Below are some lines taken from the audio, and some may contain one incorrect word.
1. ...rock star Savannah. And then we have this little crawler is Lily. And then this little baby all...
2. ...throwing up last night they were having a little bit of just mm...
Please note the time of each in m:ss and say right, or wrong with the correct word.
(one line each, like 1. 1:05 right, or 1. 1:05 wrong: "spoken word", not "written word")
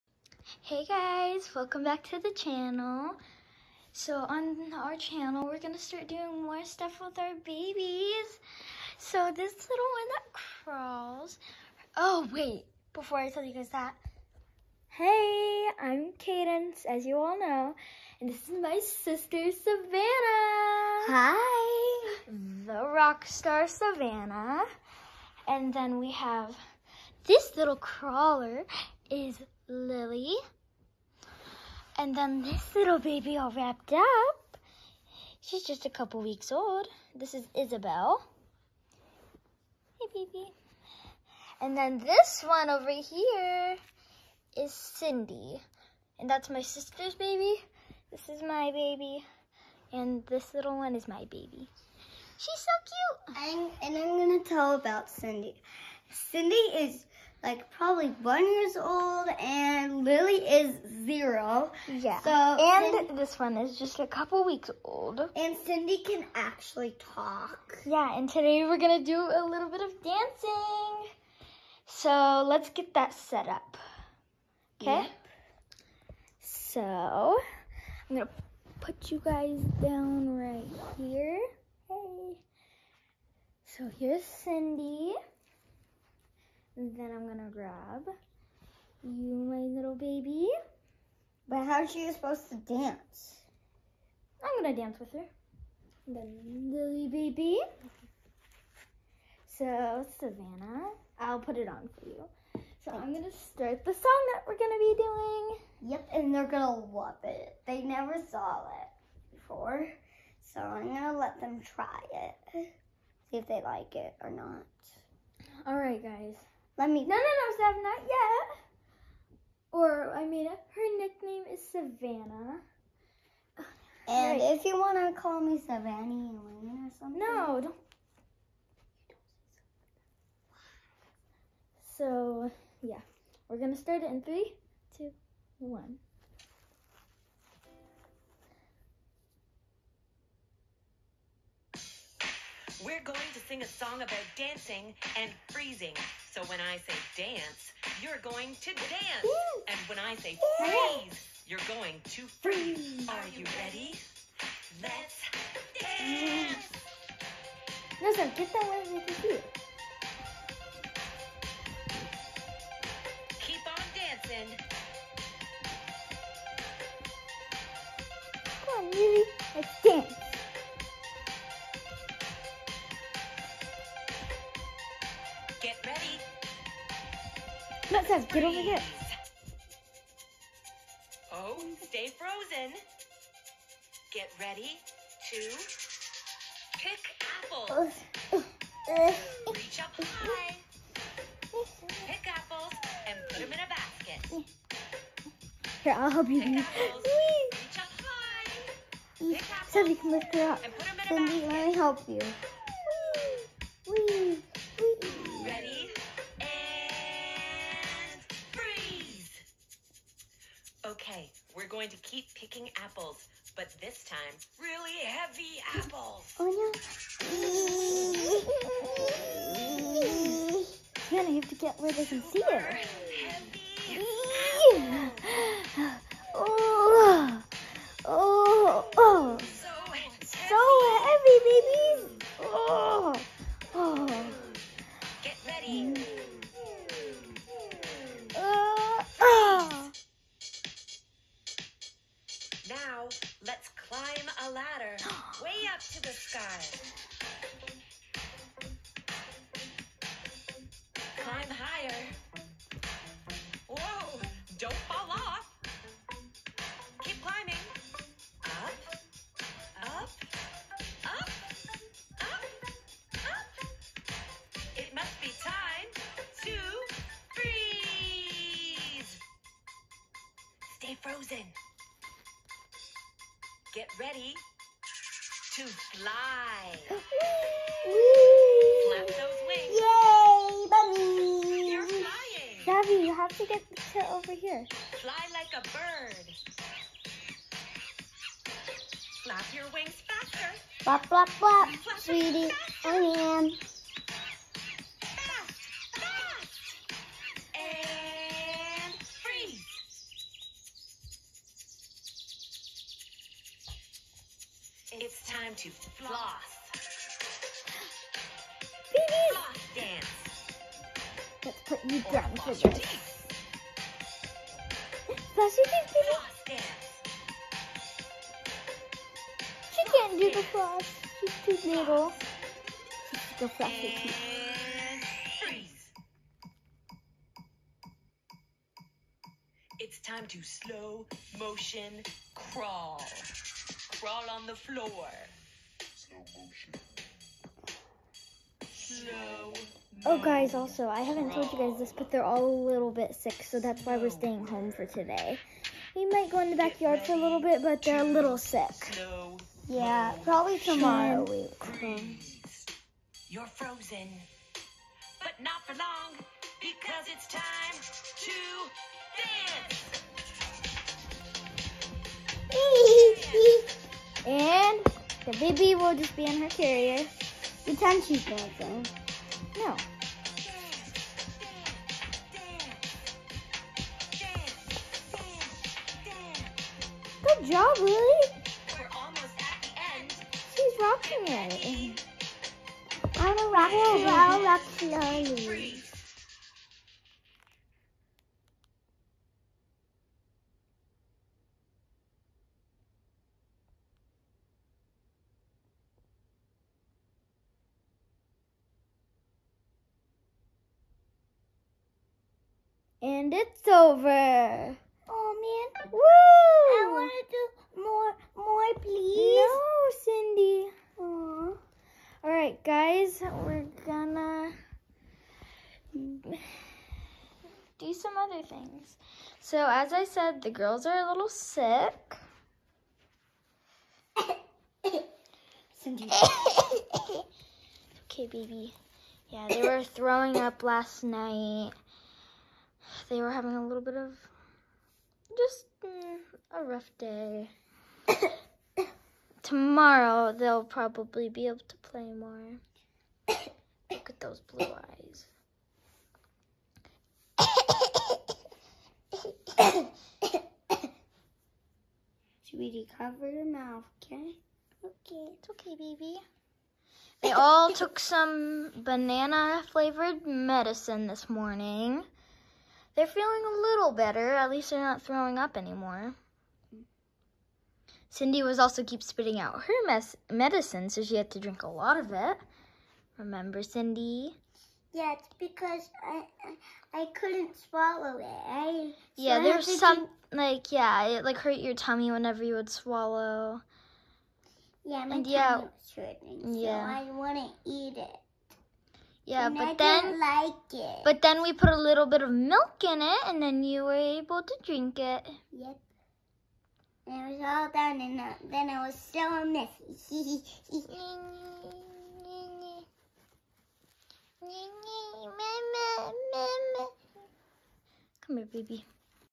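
1. 0:22 right
2. 7:09 right.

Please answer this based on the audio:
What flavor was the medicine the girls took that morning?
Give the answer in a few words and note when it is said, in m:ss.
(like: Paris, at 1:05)
Banana, at 7:38.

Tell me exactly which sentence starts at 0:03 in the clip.
So on our channel, we're gonna start doing more stuff with our babies.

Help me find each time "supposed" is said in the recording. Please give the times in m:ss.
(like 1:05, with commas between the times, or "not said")
1:32.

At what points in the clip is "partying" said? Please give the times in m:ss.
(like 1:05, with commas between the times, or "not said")
not said.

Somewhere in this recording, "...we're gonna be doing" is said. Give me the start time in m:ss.
1:44.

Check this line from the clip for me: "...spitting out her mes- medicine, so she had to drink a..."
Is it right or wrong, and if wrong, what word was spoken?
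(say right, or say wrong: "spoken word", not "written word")
right.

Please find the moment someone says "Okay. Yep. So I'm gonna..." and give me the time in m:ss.
1:14.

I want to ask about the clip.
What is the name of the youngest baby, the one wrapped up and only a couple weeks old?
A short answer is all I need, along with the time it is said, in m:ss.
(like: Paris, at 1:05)
Isabel, at 0:37.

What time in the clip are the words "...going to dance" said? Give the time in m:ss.
2:28.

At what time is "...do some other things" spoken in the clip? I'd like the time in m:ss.
6:57.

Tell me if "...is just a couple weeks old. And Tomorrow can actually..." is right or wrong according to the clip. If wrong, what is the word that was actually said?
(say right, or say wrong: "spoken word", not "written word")
wrong: "Cindy", not "Tomorrow".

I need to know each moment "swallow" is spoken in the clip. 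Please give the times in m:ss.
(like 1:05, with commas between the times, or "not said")
7:57, 8:02.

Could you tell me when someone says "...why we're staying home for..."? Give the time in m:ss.
5:43.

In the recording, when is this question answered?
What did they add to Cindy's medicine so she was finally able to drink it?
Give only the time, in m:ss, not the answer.
8:12.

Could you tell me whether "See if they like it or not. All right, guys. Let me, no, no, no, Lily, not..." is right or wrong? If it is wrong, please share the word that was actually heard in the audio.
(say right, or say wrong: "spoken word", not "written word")
wrong: "Sav", not "Lily".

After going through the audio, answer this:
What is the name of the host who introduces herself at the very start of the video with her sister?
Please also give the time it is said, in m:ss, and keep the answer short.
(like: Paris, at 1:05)
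Cadence, at 0:15.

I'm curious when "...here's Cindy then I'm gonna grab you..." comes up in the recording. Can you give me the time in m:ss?
1:23.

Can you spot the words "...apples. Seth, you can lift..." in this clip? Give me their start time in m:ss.
3:19.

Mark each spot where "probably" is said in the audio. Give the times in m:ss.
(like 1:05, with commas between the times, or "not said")
0:57, 5:50, 7:20.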